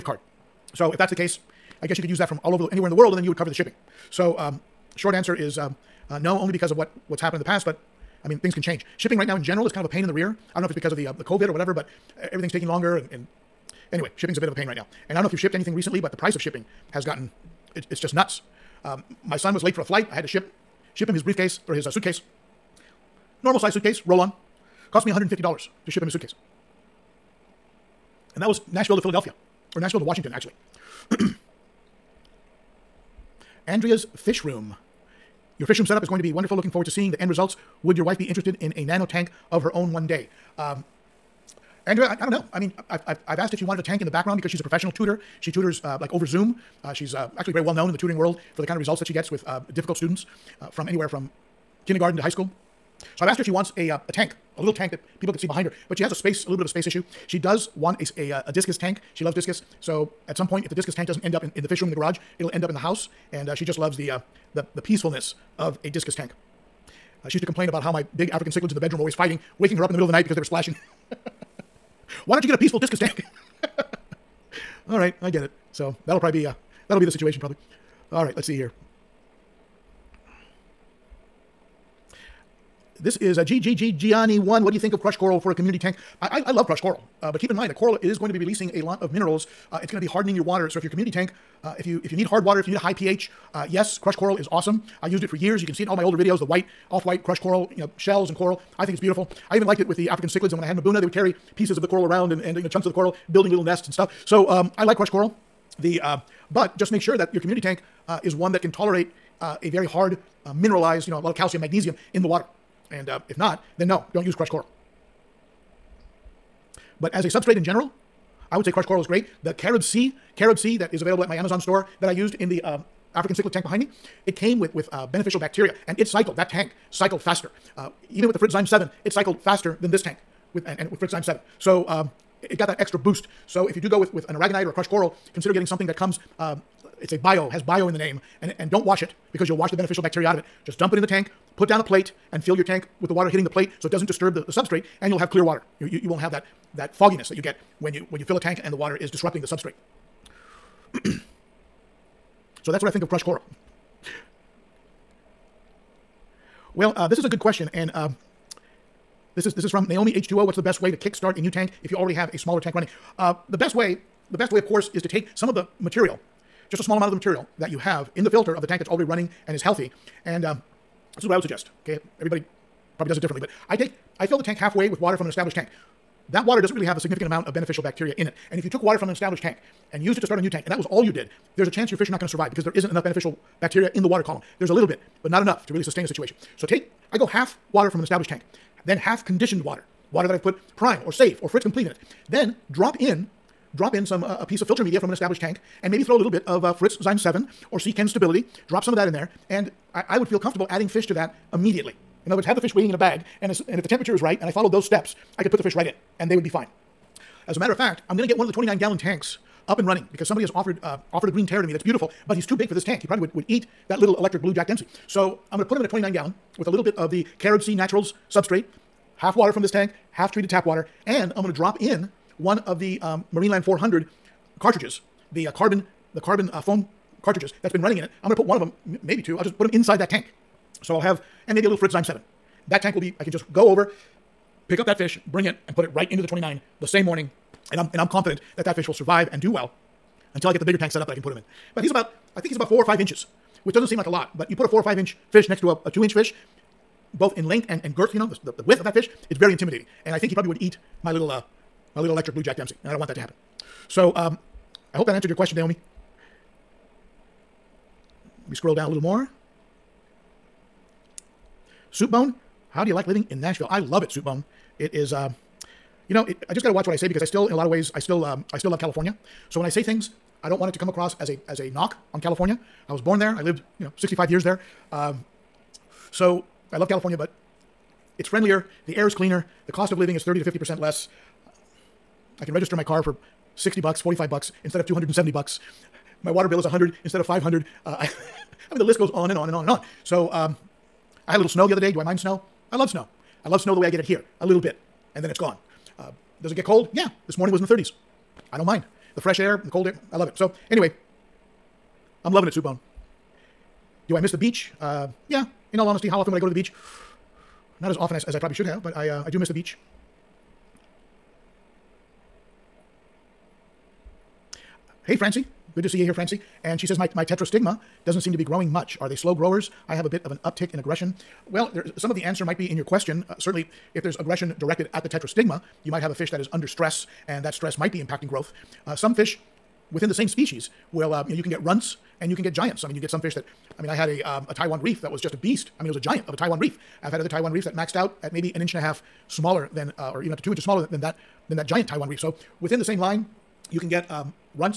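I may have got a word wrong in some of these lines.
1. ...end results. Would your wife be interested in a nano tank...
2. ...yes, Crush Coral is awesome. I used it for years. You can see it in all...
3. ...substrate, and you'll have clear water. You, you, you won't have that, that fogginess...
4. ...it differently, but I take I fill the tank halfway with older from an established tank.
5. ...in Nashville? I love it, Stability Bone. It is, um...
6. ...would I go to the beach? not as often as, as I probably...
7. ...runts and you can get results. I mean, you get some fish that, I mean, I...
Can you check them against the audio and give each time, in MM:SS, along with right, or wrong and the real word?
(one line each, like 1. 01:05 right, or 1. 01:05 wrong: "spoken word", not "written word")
1. 00:37 right
2. 01:33 right
3. 02:24 right
4. 02:53 wrong: "water", not "older"
5. 04:23 wrong: "Soup", not "Stability"
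6. 05:06 right
7. 05:31 wrong: "giants", not "results".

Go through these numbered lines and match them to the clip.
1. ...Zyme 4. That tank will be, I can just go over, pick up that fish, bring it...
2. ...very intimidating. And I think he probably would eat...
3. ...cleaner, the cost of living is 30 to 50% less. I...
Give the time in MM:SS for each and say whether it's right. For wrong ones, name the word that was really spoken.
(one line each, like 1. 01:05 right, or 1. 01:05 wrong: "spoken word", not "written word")
1. 03:51 wrong: "7", not "4"
2. 04:09 right
3. 04:39 right.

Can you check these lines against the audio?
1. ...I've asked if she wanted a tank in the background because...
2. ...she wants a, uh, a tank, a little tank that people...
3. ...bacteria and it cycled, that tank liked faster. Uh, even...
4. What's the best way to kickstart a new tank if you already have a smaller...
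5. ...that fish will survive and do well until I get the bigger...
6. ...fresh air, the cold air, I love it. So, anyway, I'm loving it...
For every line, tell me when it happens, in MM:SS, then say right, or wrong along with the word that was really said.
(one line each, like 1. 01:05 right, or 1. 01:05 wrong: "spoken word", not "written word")
1. 00:43 right
2. 00:53 right
3. 02:05 wrong: "cycled", not "liked"
4. 02:40 right
5. 03:58 right
6. 04:59 right.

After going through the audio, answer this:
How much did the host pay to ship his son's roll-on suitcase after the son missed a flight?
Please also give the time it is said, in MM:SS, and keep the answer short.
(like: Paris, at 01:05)
$150, at 00:25.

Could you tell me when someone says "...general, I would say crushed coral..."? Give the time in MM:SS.
01:57.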